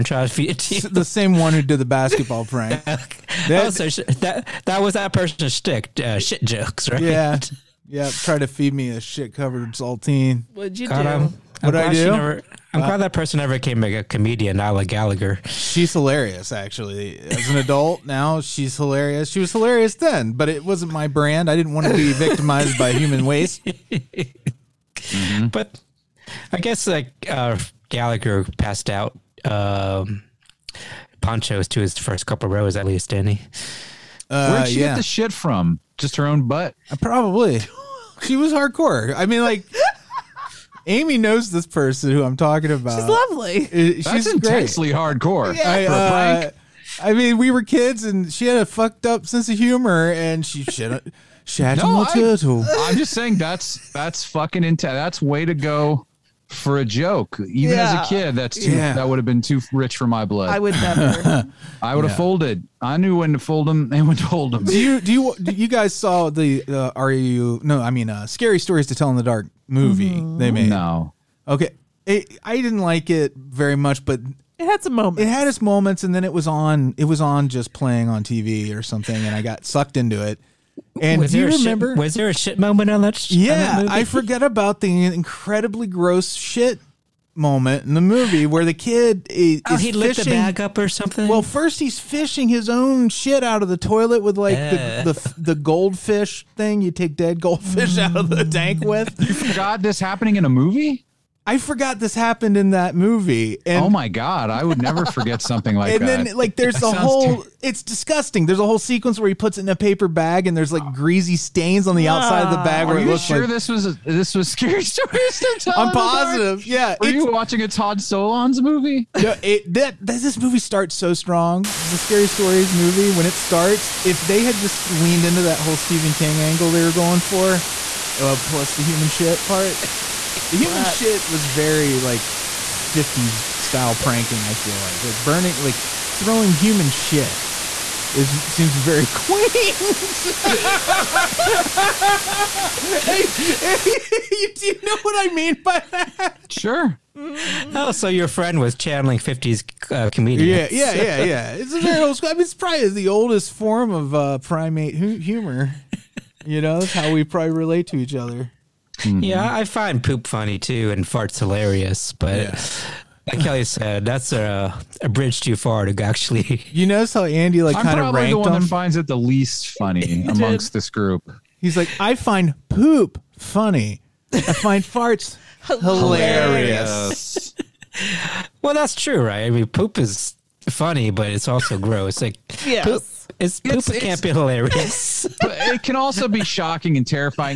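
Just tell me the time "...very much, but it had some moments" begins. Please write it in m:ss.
1:13.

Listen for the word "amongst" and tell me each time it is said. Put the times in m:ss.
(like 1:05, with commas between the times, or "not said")
2:50.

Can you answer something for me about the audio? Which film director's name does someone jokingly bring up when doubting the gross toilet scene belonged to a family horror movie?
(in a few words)
Todd Solondz.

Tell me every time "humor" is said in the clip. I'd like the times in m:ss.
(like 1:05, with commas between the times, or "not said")
0:49, 2:34.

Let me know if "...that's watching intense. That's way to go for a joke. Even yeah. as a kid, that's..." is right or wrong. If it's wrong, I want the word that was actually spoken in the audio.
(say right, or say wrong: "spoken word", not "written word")
wrong: "fucking", not "watching".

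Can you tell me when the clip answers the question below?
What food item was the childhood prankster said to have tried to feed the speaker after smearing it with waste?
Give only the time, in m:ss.
0:09.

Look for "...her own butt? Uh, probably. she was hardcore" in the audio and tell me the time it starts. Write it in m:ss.
0:36.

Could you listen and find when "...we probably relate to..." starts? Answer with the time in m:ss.
2:37.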